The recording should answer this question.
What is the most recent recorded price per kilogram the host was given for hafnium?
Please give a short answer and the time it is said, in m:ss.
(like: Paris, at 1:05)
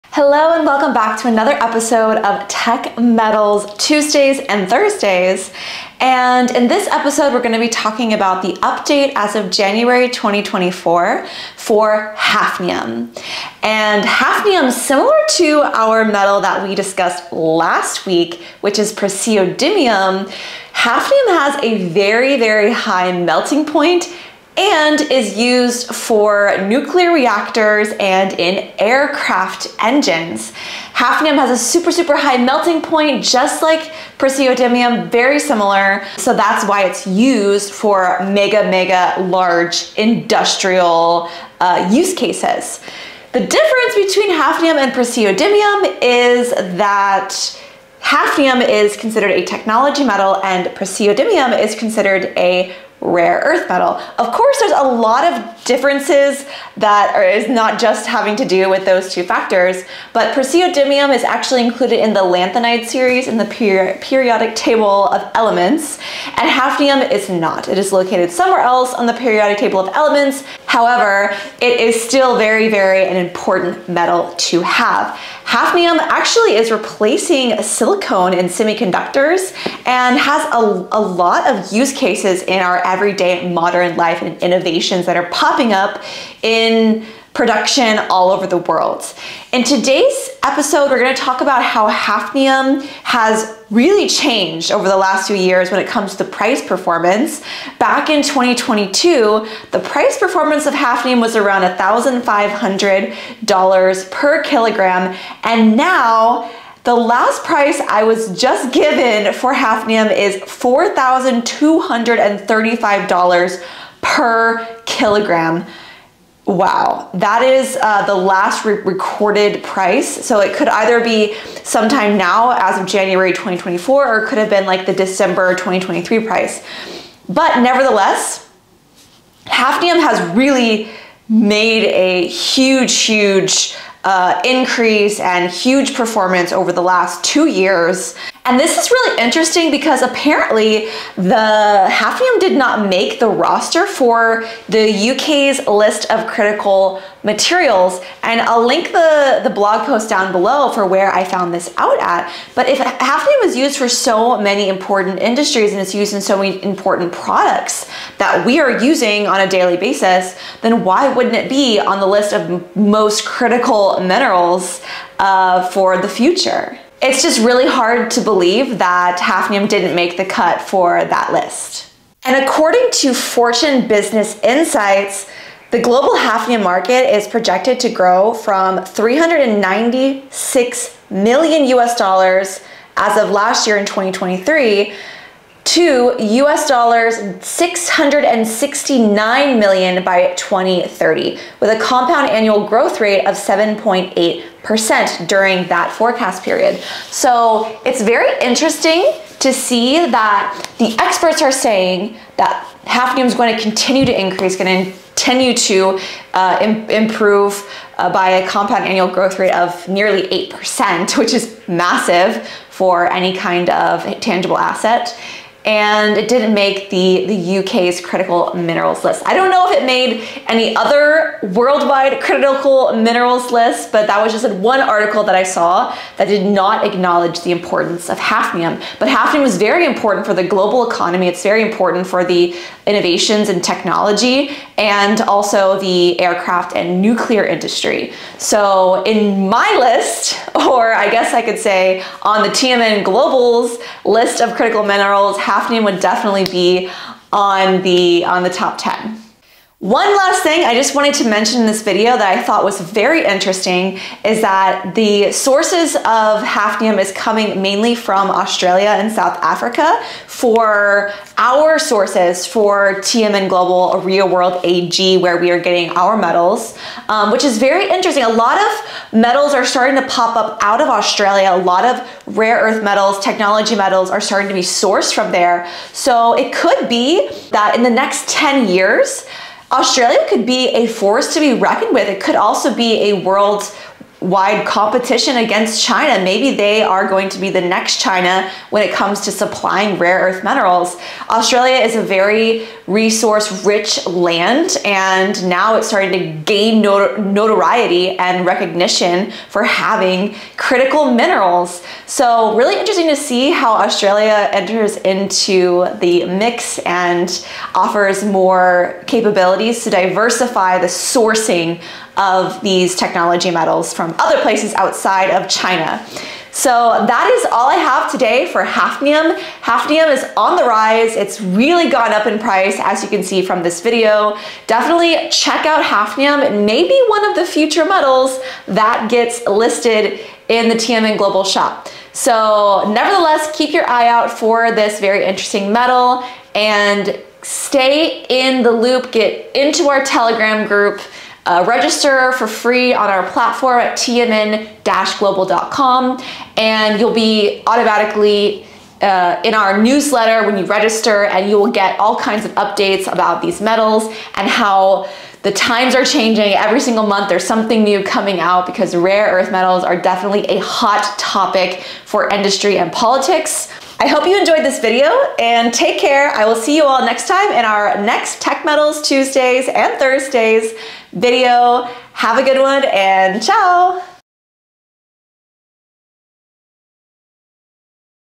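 $4,235, at 1:50.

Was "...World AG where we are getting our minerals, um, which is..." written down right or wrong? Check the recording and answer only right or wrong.
wrong.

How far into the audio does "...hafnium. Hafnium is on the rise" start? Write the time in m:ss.
5:18.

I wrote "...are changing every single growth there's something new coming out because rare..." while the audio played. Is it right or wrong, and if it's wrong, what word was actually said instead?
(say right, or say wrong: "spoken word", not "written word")
wrong: "month", not "growth".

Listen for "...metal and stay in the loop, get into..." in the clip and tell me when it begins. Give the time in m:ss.
5:35.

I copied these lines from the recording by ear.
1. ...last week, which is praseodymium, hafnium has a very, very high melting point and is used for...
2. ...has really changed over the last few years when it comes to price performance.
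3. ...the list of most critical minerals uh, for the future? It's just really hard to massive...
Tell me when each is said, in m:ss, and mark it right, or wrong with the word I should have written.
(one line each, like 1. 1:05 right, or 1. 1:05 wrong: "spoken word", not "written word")
1. 0:17 right
2. 1:33 right
3. 2:41 wrong: "believe", not "massive".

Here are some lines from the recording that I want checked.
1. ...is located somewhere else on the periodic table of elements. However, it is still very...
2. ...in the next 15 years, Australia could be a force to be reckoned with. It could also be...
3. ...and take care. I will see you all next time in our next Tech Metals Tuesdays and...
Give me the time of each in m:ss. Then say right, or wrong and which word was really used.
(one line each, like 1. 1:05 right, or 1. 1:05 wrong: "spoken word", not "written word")
1. 1:07 right
2. 4:37 wrong: "10", not "15"
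3. 6:05 right.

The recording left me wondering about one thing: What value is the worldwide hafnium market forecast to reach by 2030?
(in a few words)
669 million US dollars.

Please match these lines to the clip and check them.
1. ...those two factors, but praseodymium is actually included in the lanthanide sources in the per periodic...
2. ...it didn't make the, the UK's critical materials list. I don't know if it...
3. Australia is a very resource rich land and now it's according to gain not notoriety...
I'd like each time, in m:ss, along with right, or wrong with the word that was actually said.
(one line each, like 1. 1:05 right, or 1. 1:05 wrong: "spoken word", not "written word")
1. 0:58 wrong: "series", not "sources"
2. 3:36 wrong: "minerals", not "materials"
3. 4:51 wrong: "starting", not "according".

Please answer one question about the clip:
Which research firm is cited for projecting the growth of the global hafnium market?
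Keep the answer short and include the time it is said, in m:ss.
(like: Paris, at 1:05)
Fortune Business Insights, at 2:53.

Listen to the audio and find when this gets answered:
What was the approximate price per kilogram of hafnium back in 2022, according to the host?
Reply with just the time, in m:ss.
1:41.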